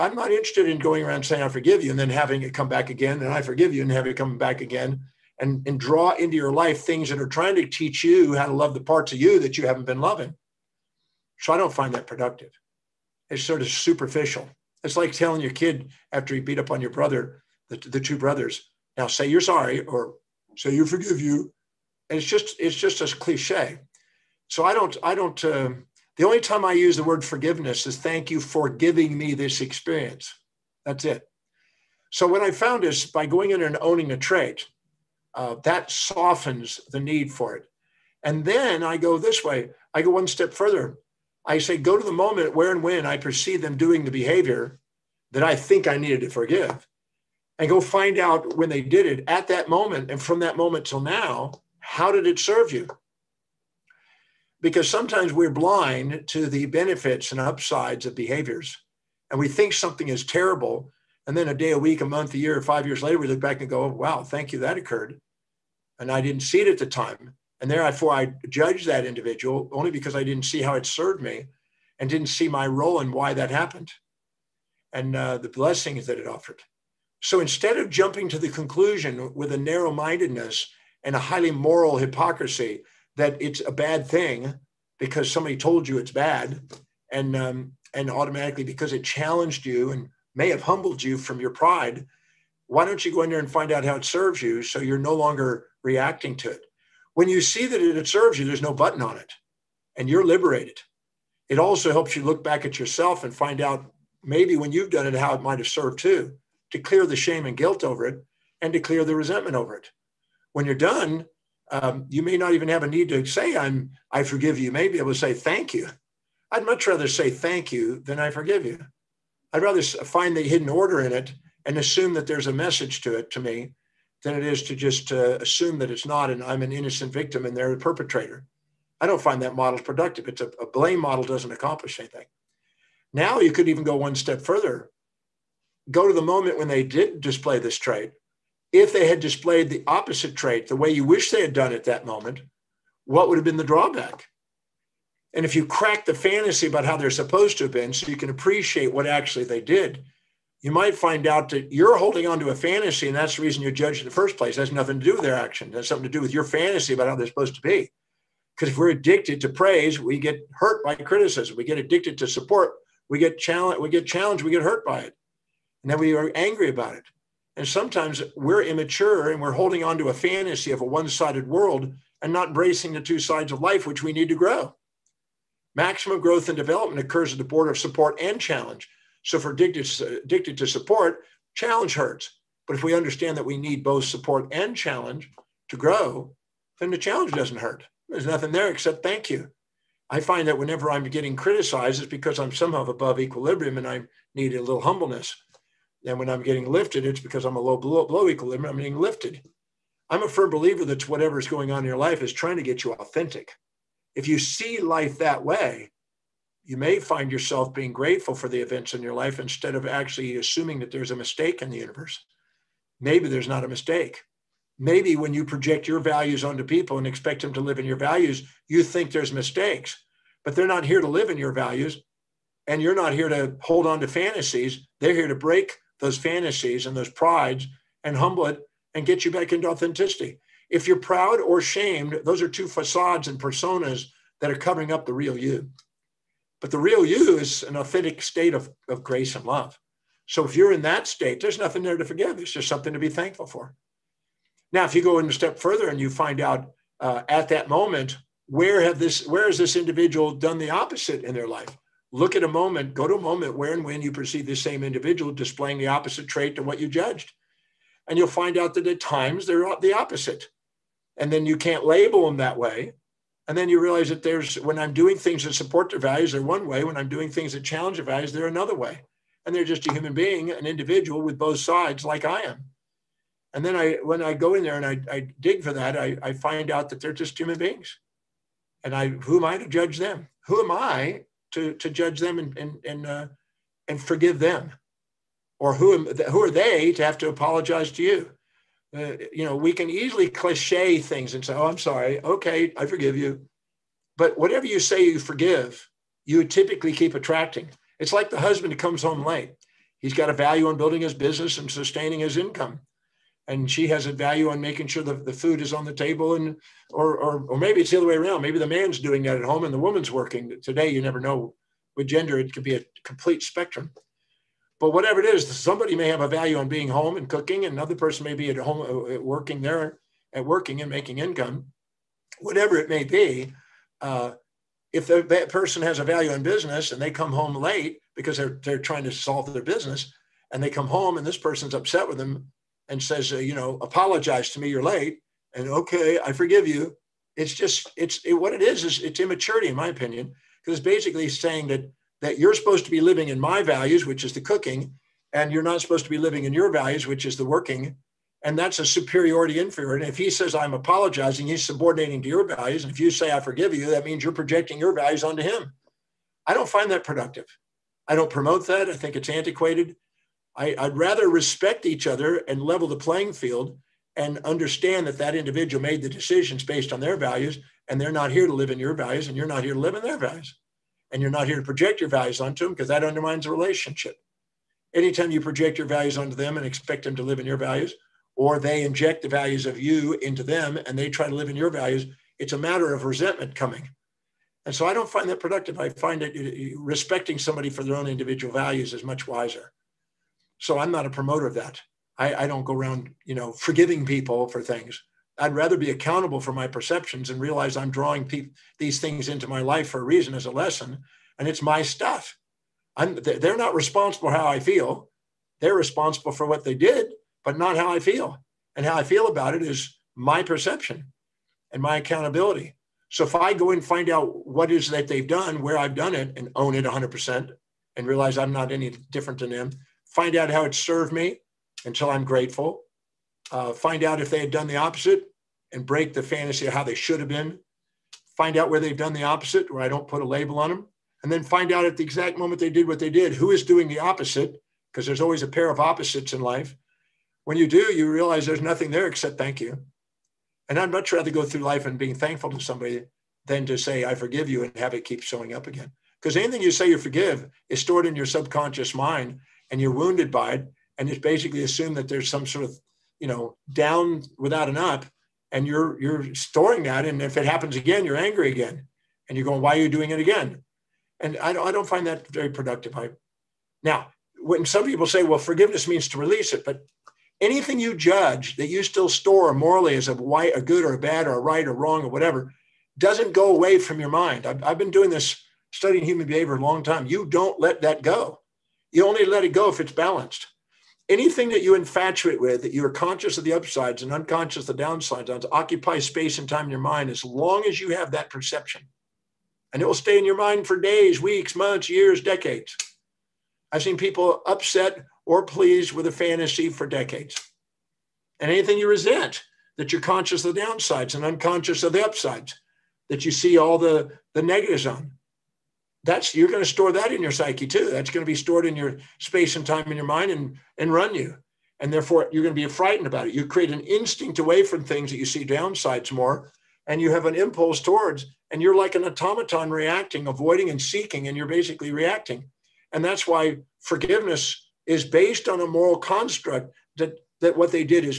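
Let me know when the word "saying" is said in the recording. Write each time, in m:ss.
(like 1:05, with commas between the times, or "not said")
0:01, 5:41.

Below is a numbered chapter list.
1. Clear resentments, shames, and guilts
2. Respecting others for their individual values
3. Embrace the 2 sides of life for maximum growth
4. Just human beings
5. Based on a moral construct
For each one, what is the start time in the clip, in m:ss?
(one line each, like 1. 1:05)
1. 0:38
2. 6:14
3. 2:25
4. 4:04
5. 7:42.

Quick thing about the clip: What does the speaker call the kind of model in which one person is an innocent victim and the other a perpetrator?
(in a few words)
a blame model.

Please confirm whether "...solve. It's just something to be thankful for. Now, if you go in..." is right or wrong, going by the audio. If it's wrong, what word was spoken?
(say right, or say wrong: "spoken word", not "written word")
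wrong: "forgive", not "solve".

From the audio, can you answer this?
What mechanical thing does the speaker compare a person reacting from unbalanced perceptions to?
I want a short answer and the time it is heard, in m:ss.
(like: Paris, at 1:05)
an automaton, at 8:38.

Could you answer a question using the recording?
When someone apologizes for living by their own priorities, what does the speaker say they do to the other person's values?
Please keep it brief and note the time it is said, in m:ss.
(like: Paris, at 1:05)
subordinating, at 5:51.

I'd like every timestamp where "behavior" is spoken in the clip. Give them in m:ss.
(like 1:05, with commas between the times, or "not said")
0:44, 0:58, 7:56.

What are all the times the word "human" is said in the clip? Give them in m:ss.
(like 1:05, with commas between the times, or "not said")
4:29, 4:37, 7:56.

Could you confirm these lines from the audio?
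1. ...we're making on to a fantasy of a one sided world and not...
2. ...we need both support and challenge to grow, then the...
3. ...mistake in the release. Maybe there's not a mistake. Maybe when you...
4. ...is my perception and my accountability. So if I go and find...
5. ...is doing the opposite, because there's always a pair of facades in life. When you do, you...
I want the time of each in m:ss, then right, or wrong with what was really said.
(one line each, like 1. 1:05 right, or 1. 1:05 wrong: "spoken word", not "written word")
1. 2:49 wrong: "holding", not "making"
2. 3:03 right
3. 3:31 wrong: "universe", not "release"
4. 6:49 right
5. 7:13 wrong: "opposites", not "facades".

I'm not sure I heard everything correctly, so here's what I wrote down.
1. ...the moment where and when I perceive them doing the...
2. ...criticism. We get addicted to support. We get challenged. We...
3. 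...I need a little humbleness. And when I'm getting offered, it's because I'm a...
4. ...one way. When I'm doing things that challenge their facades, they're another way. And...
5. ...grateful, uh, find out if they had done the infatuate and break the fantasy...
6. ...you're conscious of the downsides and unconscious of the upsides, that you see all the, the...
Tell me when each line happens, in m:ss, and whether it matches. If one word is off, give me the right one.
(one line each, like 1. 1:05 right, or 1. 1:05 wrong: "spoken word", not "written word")
1. 0:42 right
2. 2:40 right
3. 3:13 wrong: "lifted", not "offered"
4. 4:26 wrong: "values", not "facades"
5. 7:02 wrong: "opposite", not "infatuate"
6. 8:19 right.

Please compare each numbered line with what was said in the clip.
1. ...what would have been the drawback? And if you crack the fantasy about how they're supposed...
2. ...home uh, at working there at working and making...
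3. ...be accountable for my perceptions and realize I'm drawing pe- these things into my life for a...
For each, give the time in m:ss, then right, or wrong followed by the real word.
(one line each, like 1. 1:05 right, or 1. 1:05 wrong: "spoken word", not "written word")
1. 2:23 right
2. 5:18 right
3. 6:35 right.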